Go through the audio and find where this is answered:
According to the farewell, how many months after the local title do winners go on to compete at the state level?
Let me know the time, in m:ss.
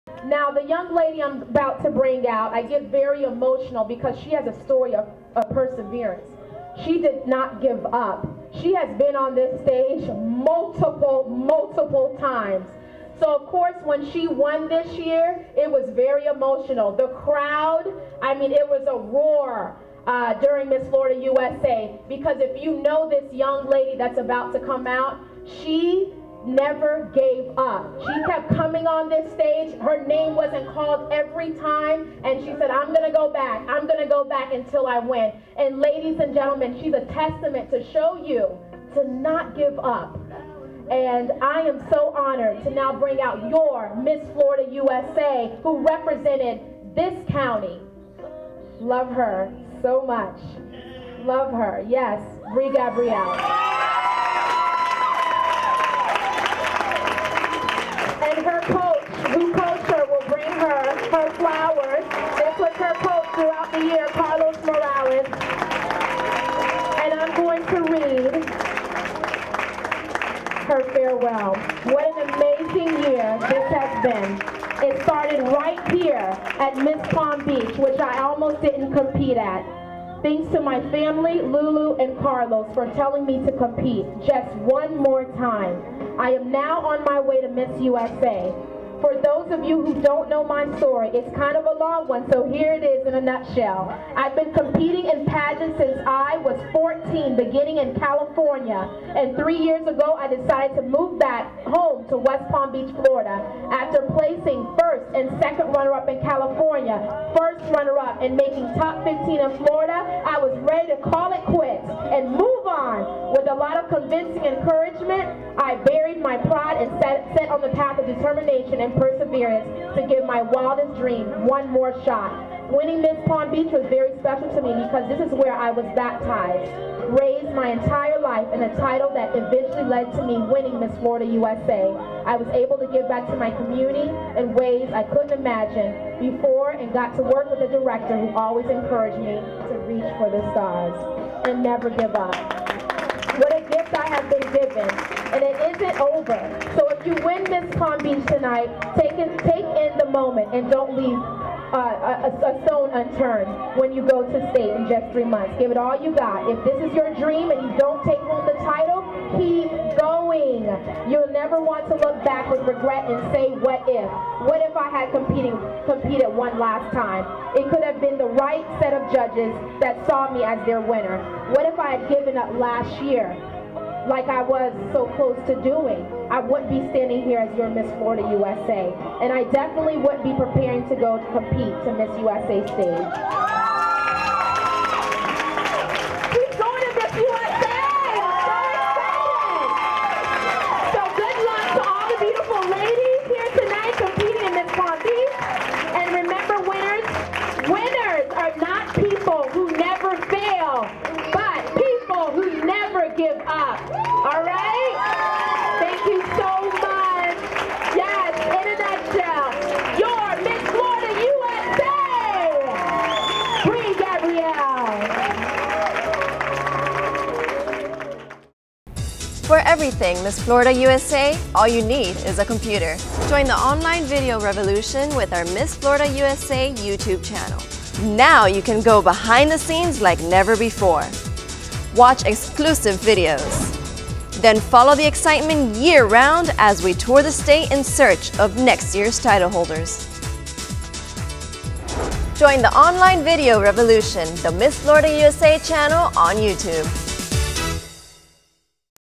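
2:35.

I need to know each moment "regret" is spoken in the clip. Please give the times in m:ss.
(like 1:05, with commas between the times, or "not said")
2:42.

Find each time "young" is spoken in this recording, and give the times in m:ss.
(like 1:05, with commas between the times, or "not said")
0:00, 0:23.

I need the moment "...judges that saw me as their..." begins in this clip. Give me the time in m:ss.
2:49.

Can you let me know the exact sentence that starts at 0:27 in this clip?
She kept coming on this stage.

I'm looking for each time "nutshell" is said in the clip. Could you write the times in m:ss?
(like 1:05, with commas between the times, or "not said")
1:33, 3:28.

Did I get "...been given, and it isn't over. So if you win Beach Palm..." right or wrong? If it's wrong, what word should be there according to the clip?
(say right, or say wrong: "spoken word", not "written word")
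wrong: "Miss", not "Beach".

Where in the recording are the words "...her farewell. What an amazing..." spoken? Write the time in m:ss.
1:10.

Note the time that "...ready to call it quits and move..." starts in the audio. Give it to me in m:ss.
1:50.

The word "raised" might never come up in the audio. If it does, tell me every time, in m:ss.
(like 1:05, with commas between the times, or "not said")
2:07.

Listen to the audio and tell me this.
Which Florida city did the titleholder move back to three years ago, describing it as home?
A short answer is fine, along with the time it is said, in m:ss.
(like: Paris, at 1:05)
West Palm Beach, at 1:42.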